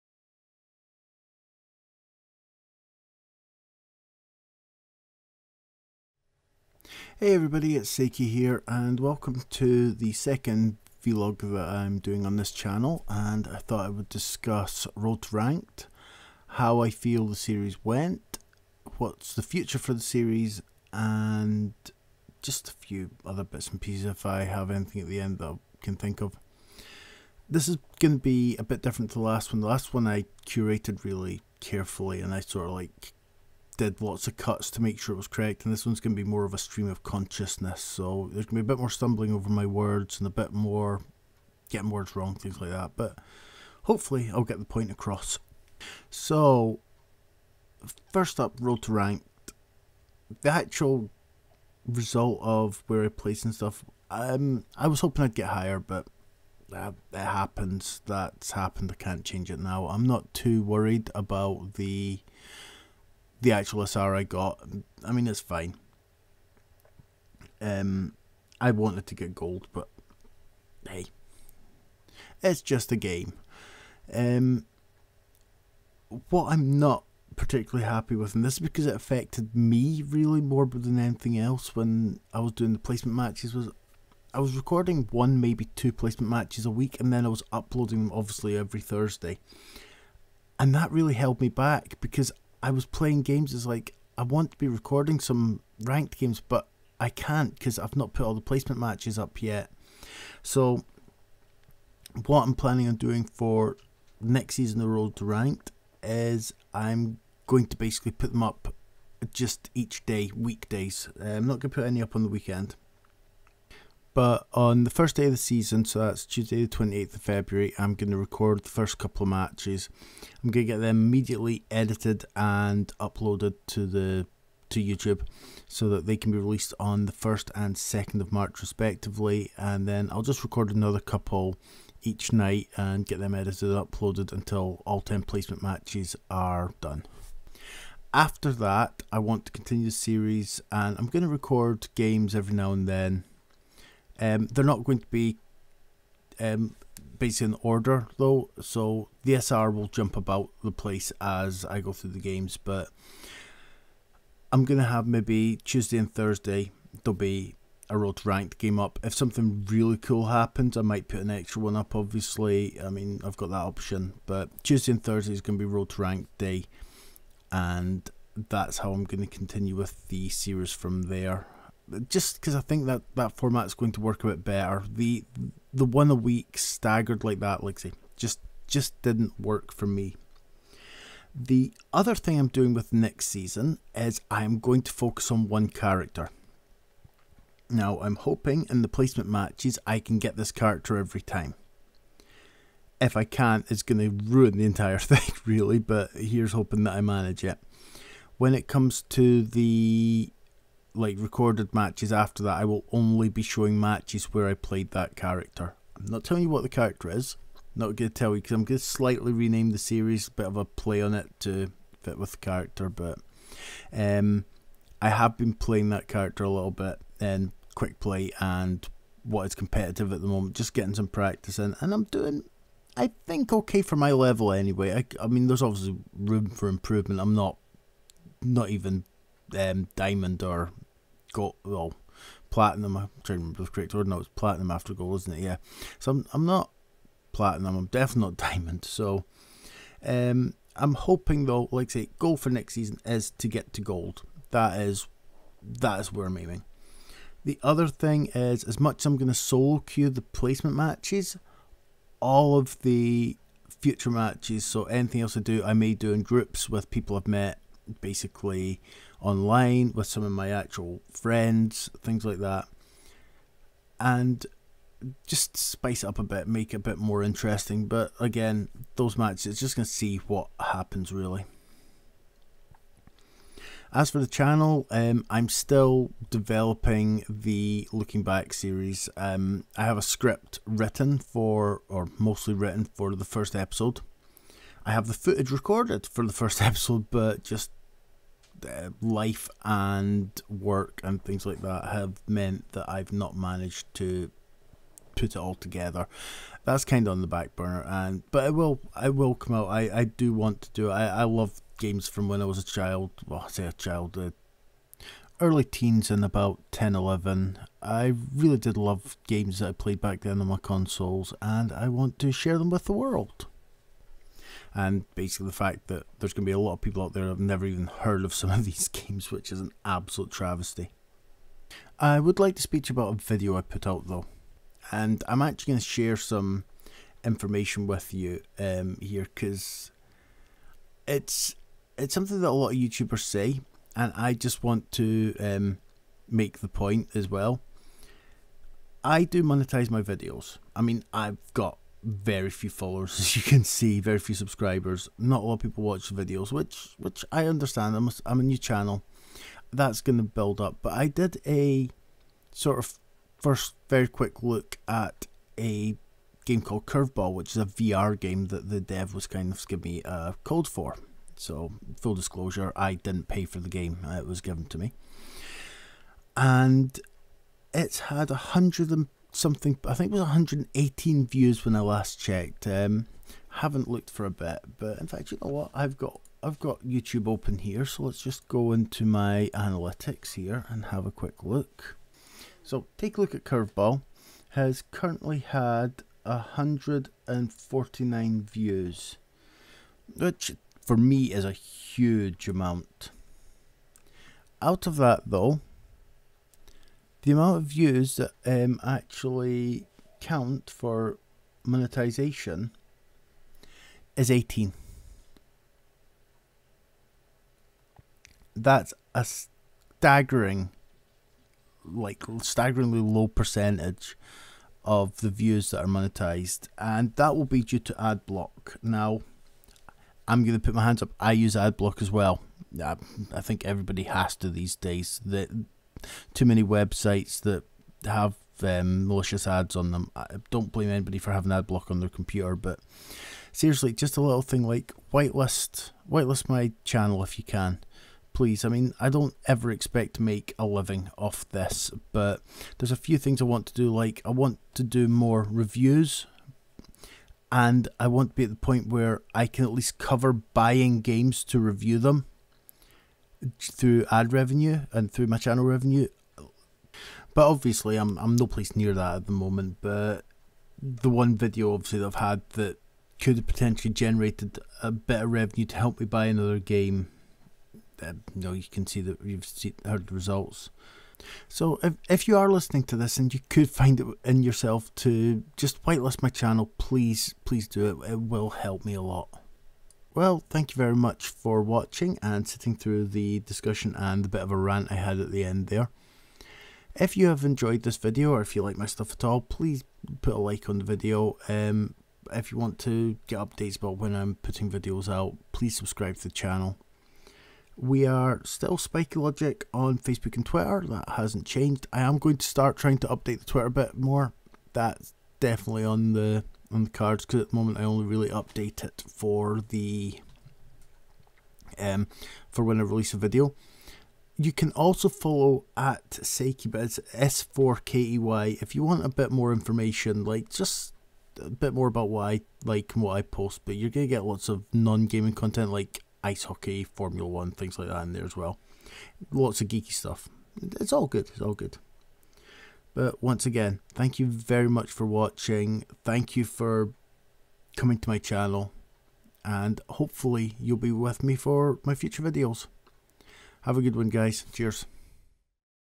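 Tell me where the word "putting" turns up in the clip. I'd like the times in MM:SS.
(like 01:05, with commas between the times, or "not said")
08:14.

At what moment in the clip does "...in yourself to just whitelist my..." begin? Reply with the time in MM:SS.
07:54.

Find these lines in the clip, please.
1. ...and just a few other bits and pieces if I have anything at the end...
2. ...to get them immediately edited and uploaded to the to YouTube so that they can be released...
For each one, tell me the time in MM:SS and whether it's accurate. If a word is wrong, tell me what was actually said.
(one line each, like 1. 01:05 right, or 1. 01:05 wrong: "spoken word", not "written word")
1. 00:20 right
2. 02:00 right.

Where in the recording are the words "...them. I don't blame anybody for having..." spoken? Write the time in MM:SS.
07:09.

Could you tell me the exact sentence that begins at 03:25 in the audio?
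I'm not telling you what the character is.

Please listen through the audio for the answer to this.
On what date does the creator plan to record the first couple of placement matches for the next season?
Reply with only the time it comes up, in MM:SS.
01:56.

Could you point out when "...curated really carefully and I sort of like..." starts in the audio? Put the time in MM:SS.
00:30.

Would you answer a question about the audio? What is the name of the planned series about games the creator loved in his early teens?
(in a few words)
Looking Back.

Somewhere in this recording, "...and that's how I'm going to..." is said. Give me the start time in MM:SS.
02:47.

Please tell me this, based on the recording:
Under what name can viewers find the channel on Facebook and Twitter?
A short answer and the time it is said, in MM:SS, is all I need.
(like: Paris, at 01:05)
SpikeyLogic, at 08:18.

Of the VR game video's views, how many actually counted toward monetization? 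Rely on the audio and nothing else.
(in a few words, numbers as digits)
18.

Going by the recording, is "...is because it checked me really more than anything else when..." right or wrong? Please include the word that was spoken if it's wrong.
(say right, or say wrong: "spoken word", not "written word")
wrong: "affected", not "checked".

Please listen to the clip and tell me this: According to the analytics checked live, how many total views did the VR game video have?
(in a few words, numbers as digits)
149.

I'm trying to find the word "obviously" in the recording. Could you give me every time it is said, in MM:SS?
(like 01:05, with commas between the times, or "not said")
01:28, 02:41, 03:45, 07:37, 07:41.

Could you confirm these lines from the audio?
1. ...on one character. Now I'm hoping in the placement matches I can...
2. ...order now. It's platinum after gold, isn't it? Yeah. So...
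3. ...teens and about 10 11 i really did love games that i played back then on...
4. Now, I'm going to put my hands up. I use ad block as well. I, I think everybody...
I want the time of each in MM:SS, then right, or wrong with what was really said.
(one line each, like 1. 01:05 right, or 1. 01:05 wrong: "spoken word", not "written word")
1. 03:05 right
2. 03:53 right
3. 05:05 right
4. 06:58 right.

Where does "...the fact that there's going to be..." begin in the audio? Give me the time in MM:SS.
05:15.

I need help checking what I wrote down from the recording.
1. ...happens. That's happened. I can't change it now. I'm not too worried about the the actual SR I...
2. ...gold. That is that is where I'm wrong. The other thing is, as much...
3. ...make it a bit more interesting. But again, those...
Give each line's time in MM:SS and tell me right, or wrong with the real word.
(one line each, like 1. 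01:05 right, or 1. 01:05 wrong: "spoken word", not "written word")
1. 00:57 right
2. 04:03 wrong: "aiming", not "wrong"
3. 04:26 right.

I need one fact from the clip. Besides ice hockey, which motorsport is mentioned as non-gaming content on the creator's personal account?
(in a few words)
Formula One.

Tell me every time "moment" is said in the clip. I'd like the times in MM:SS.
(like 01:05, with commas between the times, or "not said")
03:40, 07:39, 08:27.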